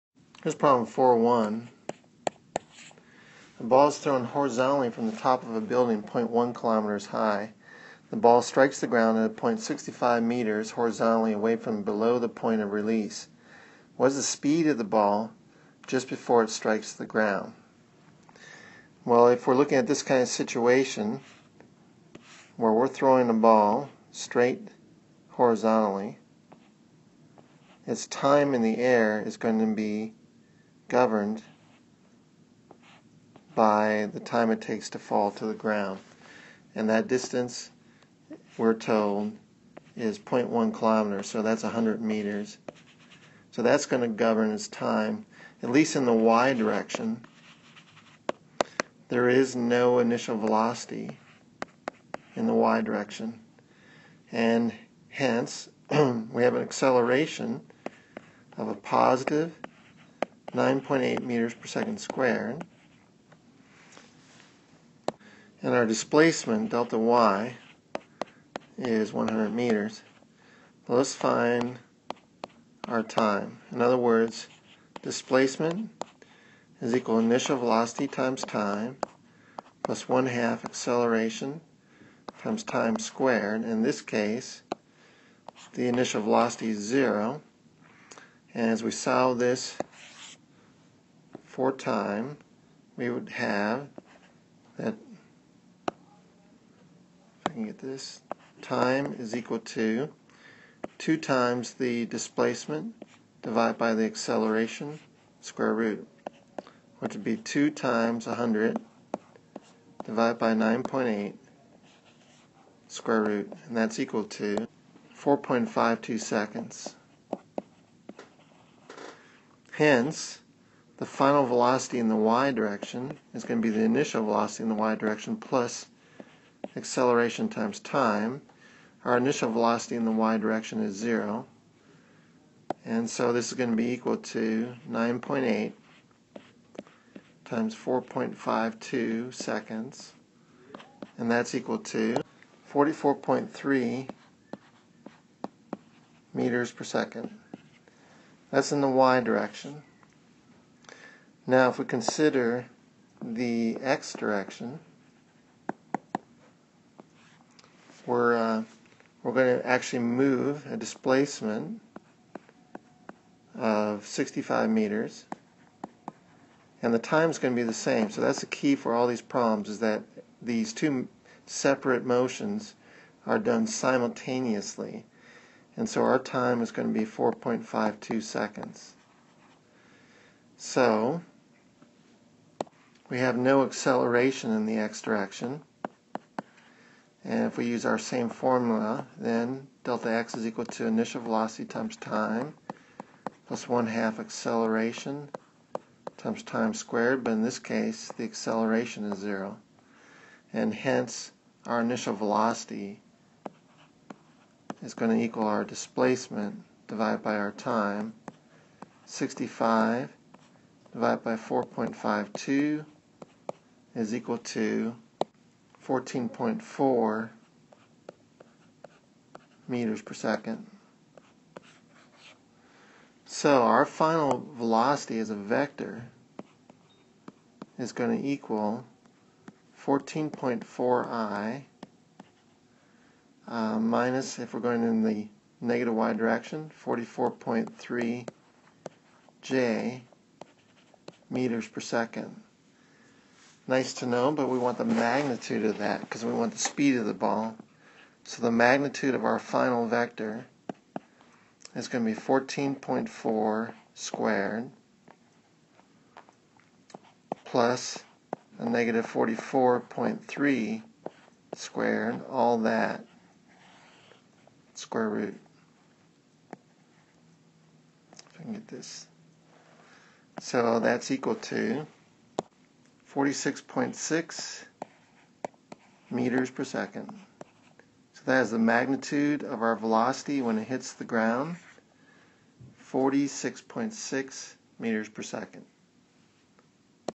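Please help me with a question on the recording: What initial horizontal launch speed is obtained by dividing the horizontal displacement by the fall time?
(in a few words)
14.4 meters per second.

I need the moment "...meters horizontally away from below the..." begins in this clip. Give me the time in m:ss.
0:10.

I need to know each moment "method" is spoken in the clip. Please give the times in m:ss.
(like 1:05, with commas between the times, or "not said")
not said.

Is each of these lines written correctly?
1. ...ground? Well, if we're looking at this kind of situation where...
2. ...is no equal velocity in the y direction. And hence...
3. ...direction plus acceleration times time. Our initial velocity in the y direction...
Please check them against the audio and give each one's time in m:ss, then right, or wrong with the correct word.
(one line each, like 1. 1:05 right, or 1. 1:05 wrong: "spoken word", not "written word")
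1. 0:17 right
2. 0:49 wrong: "initial", not "equal"
3. 2:04 right.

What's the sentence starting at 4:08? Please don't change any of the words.
So the magnitude of our final vector is going to be 14.4 squared plus a negative 44.3 squared, all that square root.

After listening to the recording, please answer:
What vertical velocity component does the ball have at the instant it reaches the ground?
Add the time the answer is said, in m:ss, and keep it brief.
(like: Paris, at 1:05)
44.3 meters per second, at 2:22.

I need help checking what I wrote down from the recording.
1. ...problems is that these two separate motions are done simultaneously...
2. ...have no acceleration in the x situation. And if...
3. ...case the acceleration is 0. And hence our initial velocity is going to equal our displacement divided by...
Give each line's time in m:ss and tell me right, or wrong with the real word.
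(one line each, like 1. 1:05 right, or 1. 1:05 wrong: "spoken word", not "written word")
1. 2:49 right
2. 3:03 wrong: "direction", not "situation"
3. 3:17 right.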